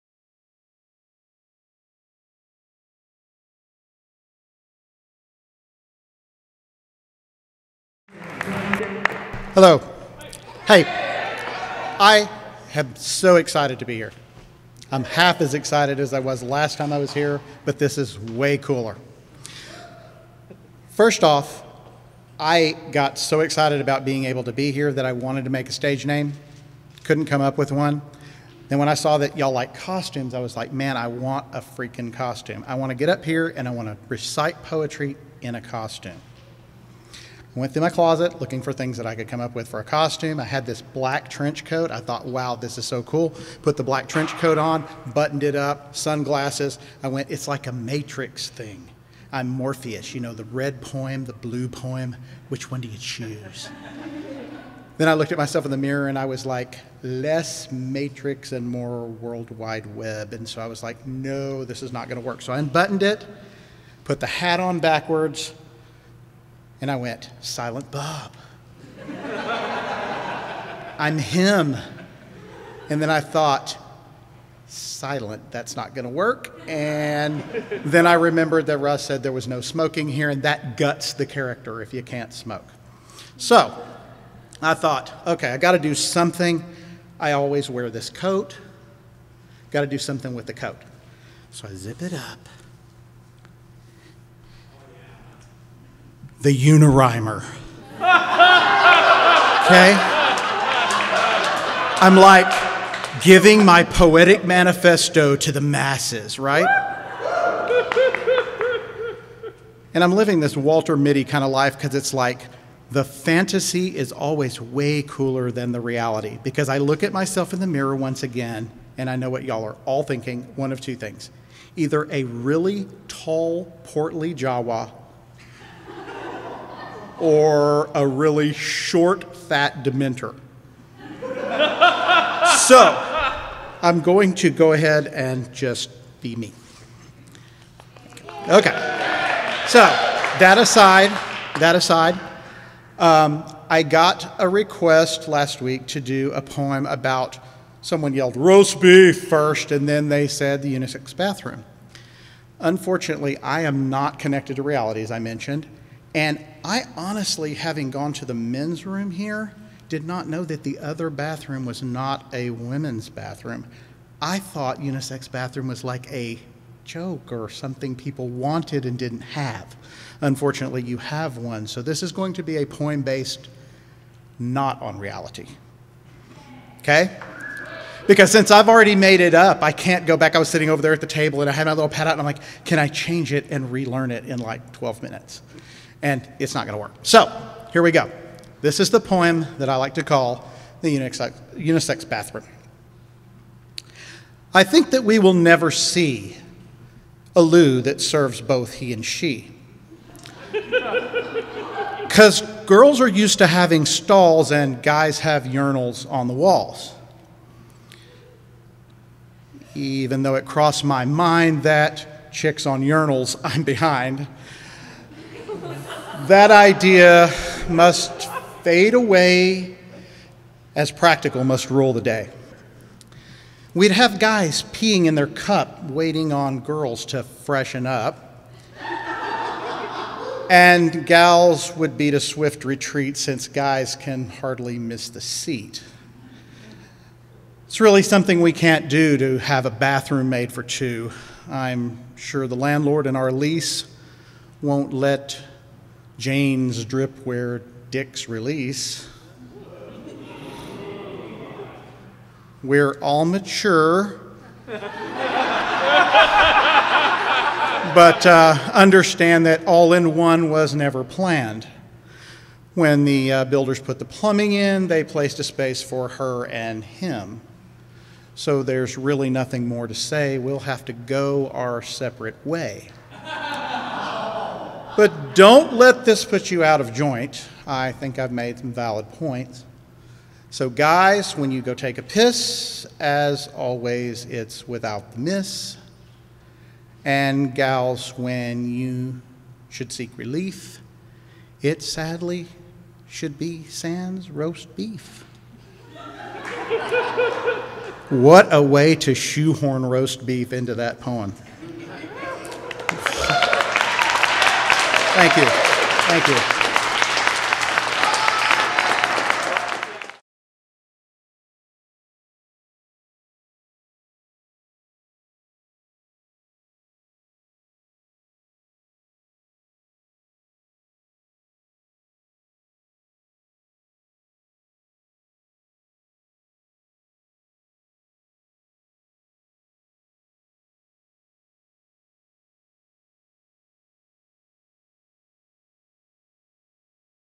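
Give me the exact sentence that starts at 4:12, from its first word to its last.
We're all mature, but uh, understand that all in one was never planned.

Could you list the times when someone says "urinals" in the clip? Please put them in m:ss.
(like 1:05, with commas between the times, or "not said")
3:25, 3:32.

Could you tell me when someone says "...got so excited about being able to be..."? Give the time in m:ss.
0:22.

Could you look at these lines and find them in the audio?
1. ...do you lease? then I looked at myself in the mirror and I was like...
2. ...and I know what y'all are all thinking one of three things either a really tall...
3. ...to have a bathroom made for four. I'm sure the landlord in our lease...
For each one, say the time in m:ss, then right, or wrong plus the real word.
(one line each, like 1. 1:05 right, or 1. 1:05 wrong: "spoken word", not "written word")
1. 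0:52 wrong: "choose", not "lease"
2. 1:58 wrong: "two", not "three"
3. 3:59 wrong: "two", not "four".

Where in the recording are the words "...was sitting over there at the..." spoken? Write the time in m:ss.
3:00.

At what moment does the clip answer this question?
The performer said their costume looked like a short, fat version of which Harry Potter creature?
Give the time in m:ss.
2:09.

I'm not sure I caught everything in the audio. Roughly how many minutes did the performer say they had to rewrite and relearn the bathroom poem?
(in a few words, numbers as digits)
12.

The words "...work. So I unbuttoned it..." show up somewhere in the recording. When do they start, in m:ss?
1:02.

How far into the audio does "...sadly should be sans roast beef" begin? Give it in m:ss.
4:51.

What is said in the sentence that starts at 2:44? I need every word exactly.
I thought unisex bathroom was like a joke or something people wanted and didn't have.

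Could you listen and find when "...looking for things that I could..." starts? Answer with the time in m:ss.
0:38.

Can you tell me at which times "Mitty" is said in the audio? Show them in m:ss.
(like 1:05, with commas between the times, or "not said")
1:50.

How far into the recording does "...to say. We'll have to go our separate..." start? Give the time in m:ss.
4:29.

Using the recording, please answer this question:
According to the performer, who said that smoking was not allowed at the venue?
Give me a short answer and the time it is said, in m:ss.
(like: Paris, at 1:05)
Russ, at 1:18.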